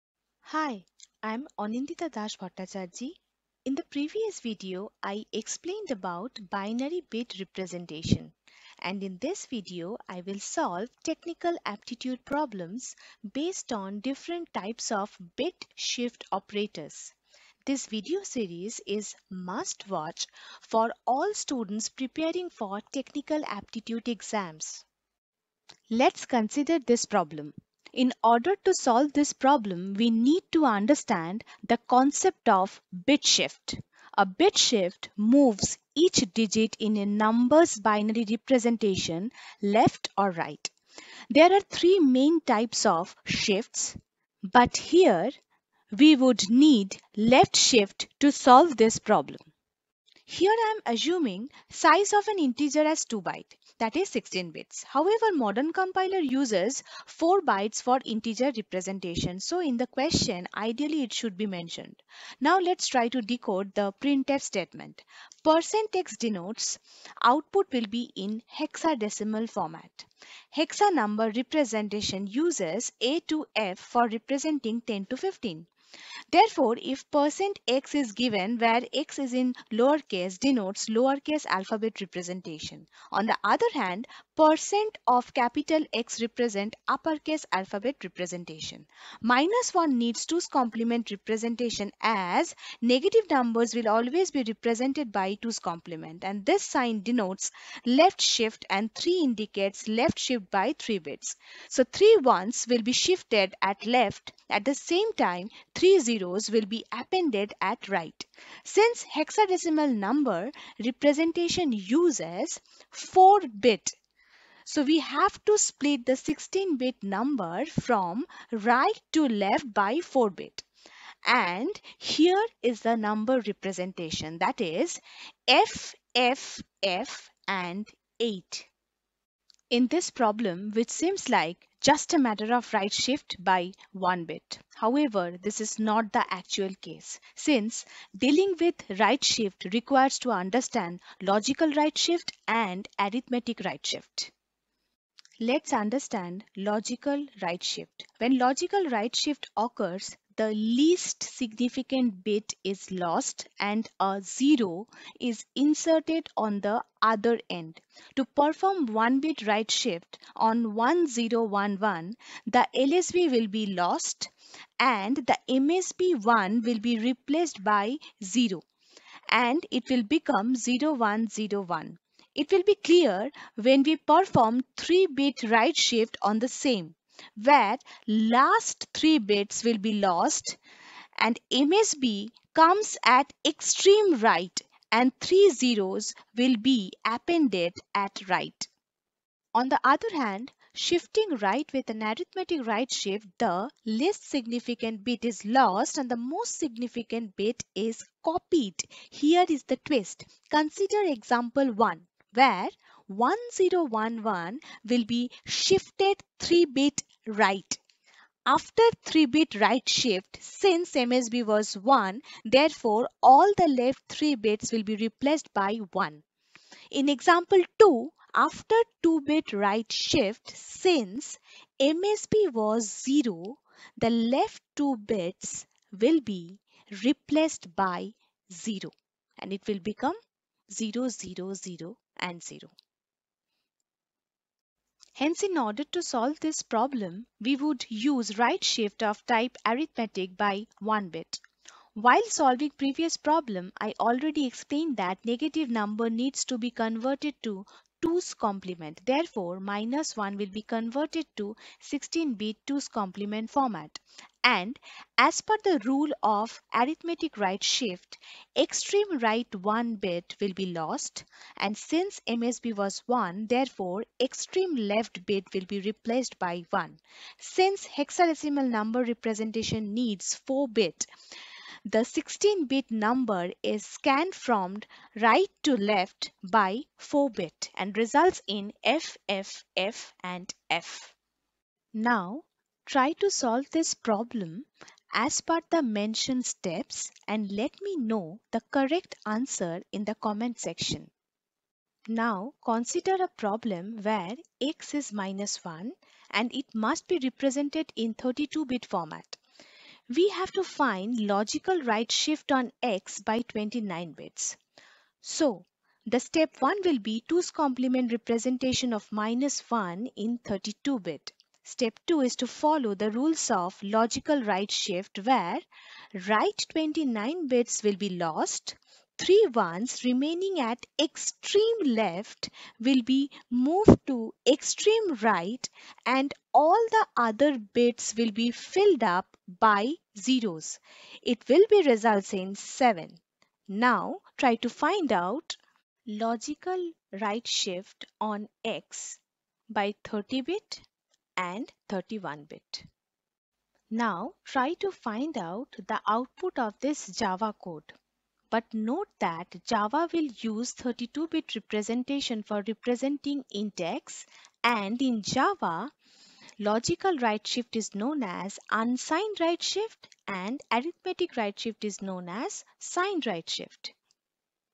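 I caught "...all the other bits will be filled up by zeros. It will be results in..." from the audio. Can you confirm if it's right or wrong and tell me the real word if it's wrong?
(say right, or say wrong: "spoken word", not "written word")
right.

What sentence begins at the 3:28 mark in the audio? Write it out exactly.
After 3-bit right shift, since MSB was 1, therefore all the left 3 bits will be replaced by 1.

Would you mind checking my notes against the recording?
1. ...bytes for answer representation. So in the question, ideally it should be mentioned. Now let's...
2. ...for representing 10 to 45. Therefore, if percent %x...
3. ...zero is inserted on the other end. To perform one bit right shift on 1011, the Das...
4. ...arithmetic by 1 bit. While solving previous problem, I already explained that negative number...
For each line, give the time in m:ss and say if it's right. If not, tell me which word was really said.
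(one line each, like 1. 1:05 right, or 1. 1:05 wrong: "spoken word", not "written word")
1. 0:57 wrong: "integer", not "answer"
2. 1:13 wrong: "15", not "45"
3. 2:34 wrong: "LSB", not "Das"
4. 3:59 right.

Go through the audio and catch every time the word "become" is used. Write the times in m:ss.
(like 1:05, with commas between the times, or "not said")
2:50, 3:49.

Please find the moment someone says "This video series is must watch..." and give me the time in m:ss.
0:17.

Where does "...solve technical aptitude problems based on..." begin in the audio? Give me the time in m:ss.
0:10.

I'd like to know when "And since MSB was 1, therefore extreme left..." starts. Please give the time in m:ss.
4:21.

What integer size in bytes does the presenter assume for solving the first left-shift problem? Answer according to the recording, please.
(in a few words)
2.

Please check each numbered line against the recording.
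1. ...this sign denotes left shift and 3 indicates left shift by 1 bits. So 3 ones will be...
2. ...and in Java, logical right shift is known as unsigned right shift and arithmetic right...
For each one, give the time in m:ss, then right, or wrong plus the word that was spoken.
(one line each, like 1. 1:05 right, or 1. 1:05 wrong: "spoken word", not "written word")
1. 1:36 wrong: "3", not "1"
2. 5:54 right.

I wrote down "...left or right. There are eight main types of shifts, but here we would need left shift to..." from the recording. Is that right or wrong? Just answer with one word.
wrong.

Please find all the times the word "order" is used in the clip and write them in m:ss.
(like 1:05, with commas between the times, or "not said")
0:28, 3:55.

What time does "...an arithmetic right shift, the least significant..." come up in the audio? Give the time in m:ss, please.
3:11.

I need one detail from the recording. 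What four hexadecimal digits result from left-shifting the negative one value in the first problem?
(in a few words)
FFF8.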